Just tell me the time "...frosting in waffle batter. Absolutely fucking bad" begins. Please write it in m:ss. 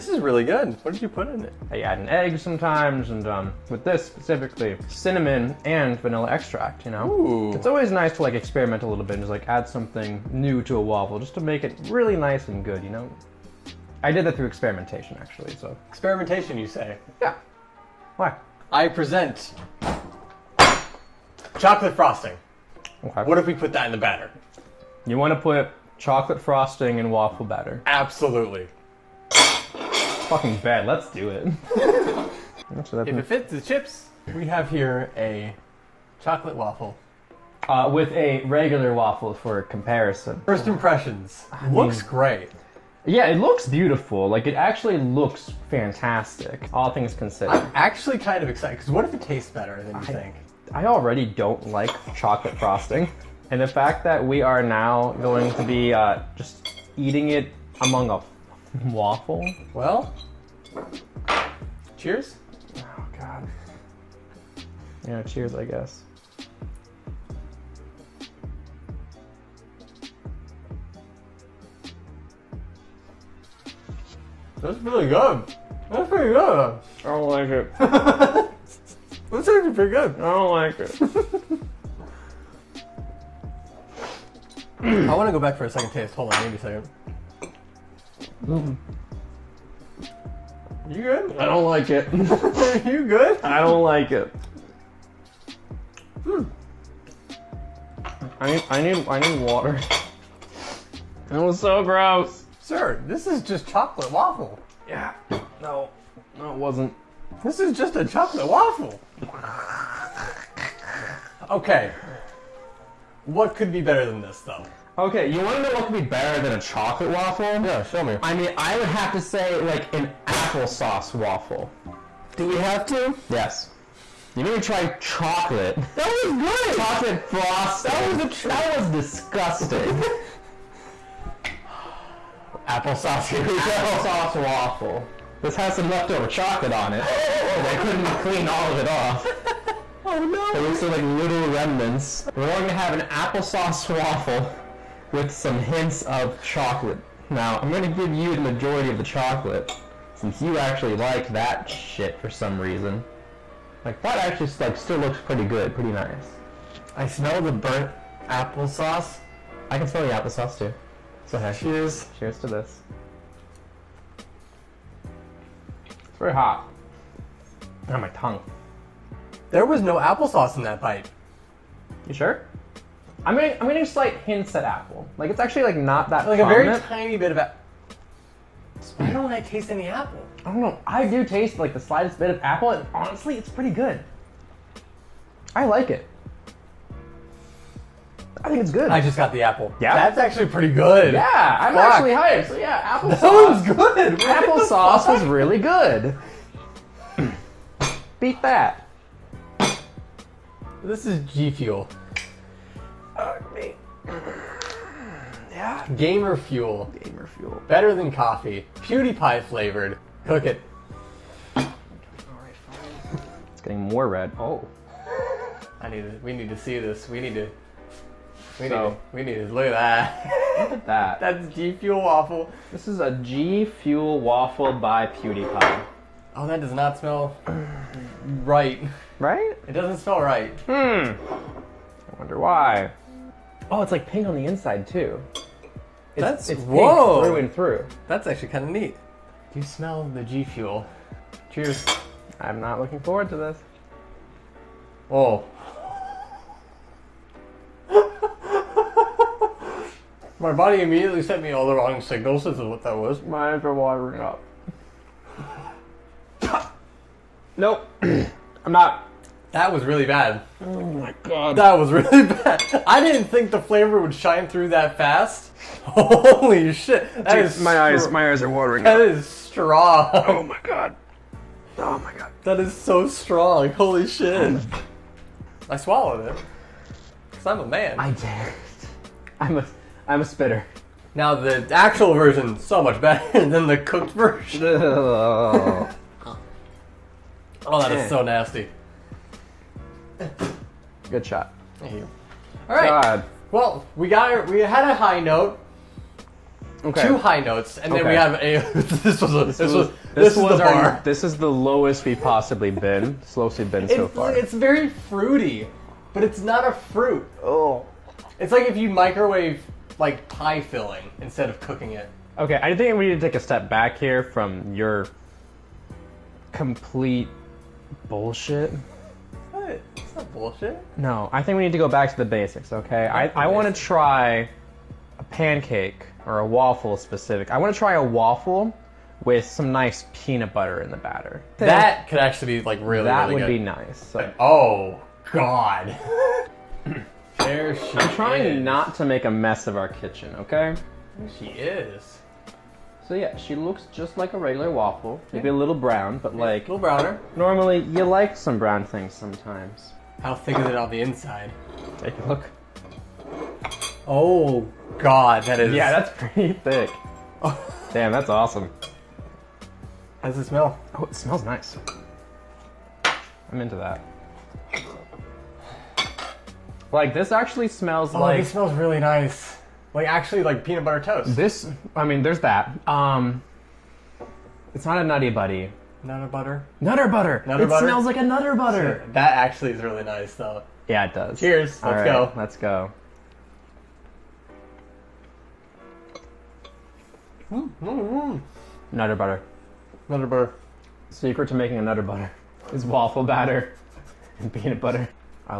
0:26.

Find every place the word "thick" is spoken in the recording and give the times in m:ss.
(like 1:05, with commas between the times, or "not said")
5:50, 5:56.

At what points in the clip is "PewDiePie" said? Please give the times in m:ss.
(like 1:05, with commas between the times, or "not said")
3:28, 3:45.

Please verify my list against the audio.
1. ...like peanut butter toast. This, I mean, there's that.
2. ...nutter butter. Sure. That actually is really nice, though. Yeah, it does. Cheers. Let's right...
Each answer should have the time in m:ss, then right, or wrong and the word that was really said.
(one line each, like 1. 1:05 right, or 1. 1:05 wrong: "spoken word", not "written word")
1. 6:10 right
2. 6:18 right.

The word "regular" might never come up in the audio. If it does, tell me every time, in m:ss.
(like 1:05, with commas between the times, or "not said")
0:38, 5:44.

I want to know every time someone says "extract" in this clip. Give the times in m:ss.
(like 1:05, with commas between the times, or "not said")
0:06.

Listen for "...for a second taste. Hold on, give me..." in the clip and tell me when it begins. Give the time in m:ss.
1:25.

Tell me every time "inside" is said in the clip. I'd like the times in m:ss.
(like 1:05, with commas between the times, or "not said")
3:54, 5:51.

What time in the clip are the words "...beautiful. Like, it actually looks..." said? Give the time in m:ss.
0:43.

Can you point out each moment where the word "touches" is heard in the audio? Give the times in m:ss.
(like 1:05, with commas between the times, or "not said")
not said.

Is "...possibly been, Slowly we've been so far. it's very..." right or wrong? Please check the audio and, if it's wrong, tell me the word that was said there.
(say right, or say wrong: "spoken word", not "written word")
right.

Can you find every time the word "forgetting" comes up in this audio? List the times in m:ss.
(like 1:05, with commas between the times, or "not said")
not said.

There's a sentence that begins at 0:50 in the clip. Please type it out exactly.
I already don't like chocolate frosting.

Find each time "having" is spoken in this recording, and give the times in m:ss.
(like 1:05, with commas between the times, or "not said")
not said.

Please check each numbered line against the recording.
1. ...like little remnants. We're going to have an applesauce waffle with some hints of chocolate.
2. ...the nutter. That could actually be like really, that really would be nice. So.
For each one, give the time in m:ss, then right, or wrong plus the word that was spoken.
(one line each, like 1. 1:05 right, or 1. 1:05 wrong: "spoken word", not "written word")
1. 2:20 right
2. 5:30 wrong: "batter", not "nutter".